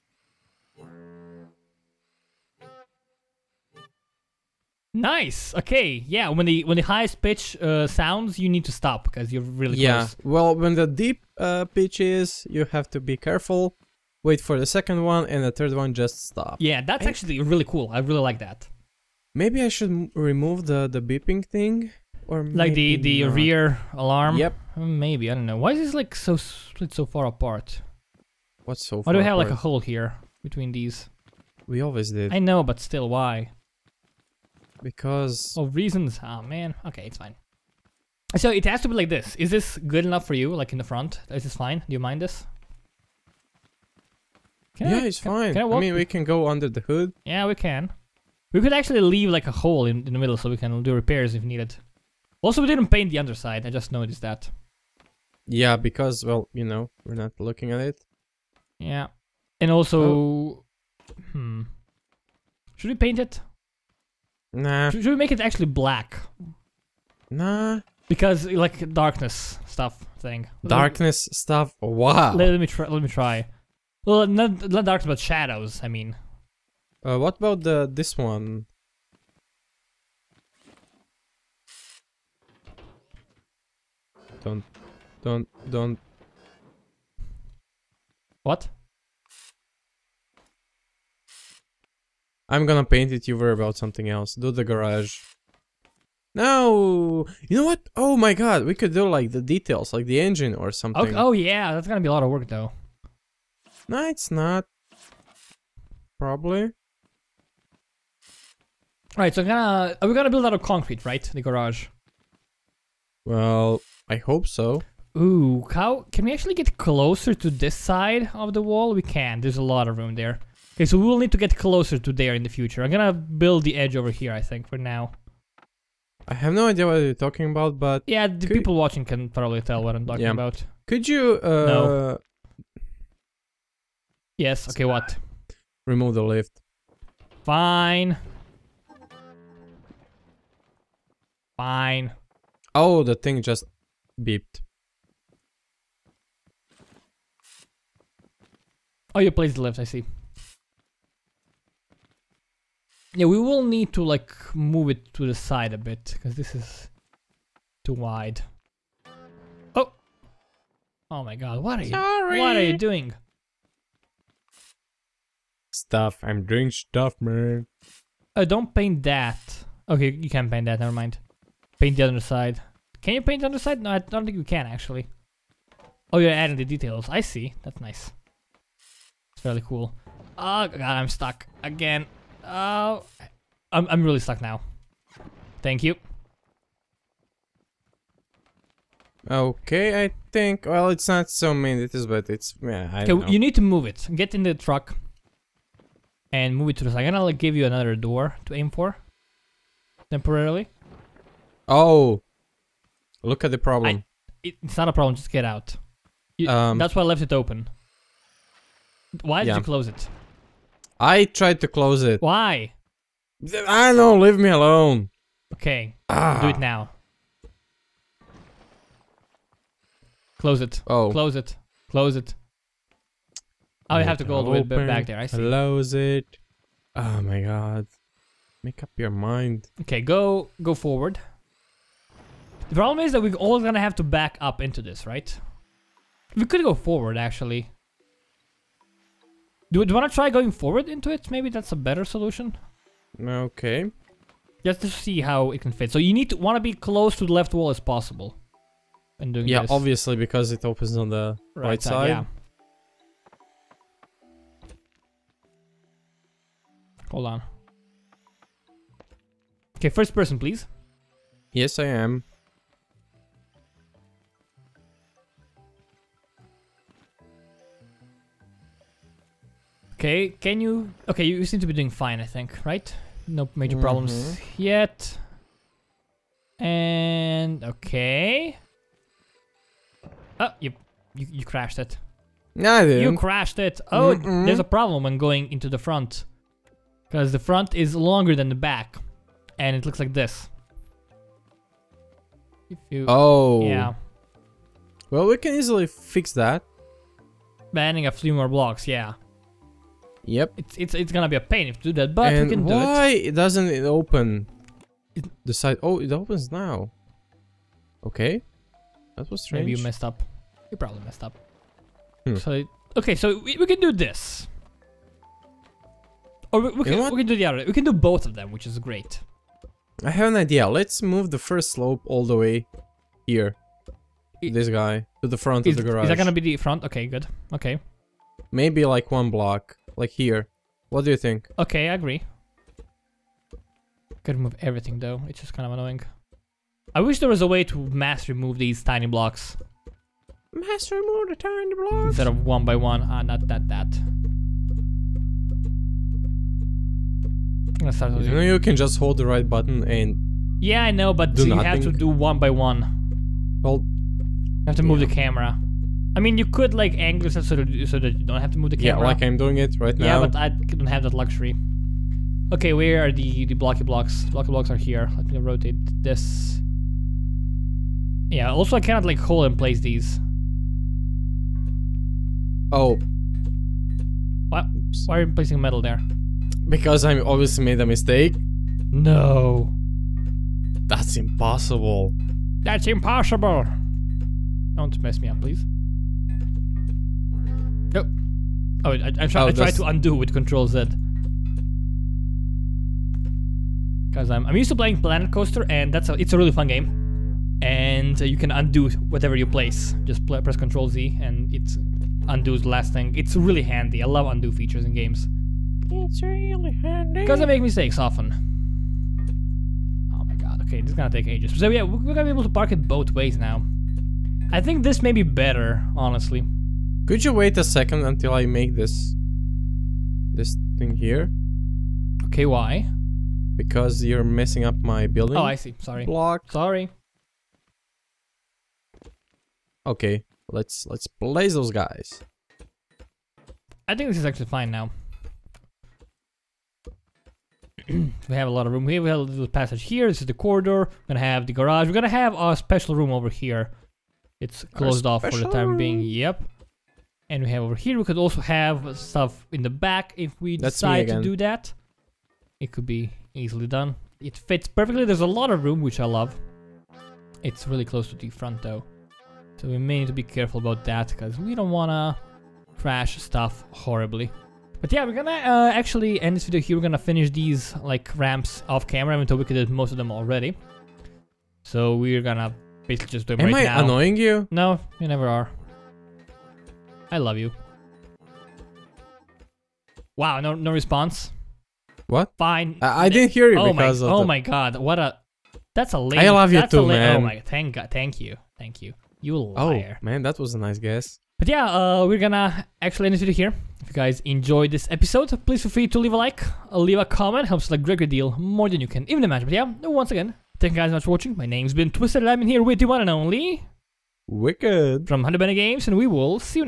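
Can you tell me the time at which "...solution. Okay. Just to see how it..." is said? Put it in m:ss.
4:02.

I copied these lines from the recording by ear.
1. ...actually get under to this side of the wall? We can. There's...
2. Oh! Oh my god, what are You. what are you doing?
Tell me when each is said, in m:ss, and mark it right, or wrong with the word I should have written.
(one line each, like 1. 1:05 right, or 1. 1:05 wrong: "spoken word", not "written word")
1. 1:56 wrong: "closer", not "under"
2. 2:39 wrong: "Sorry", not "You".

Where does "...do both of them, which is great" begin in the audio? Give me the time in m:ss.
5:17.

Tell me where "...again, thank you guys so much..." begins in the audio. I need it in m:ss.
8:20.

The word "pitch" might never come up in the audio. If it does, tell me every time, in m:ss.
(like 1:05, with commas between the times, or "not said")
0:07, 0:11.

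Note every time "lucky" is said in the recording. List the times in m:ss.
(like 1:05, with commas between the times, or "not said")
not said.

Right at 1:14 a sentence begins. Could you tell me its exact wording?
Well, not not darks, but shadows.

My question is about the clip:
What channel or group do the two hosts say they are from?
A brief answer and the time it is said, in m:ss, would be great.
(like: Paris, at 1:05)
HoneyBunny Games, at 8:25.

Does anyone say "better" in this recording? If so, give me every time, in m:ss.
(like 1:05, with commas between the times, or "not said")
4:01, 6:55.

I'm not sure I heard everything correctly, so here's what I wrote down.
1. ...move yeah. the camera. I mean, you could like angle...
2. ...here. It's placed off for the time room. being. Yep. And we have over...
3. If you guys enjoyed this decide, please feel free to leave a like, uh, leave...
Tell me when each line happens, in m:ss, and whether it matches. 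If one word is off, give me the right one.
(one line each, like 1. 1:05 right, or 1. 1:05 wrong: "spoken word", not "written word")
1. 5:54 right
2. 7:23 wrong: "closed", not "placed"
3. 8:13 wrong: "episode", not "decide".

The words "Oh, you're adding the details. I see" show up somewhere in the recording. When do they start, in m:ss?
2:56.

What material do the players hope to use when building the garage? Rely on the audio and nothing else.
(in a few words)
Concrete.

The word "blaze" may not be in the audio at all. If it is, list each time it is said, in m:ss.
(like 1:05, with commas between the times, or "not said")
7:11.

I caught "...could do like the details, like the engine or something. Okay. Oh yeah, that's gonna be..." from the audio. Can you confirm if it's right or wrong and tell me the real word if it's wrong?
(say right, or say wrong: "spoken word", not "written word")
right.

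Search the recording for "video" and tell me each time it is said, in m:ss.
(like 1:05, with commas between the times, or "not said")
7:46, 8:13.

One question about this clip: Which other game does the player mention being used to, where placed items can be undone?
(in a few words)
Planet Coaster.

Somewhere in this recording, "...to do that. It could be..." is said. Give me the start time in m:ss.
7:31.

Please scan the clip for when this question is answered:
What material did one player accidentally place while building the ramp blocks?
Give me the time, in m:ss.
6:15.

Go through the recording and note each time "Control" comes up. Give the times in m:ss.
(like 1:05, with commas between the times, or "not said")
6:30, 6:40.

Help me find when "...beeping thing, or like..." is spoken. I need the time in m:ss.
0:21.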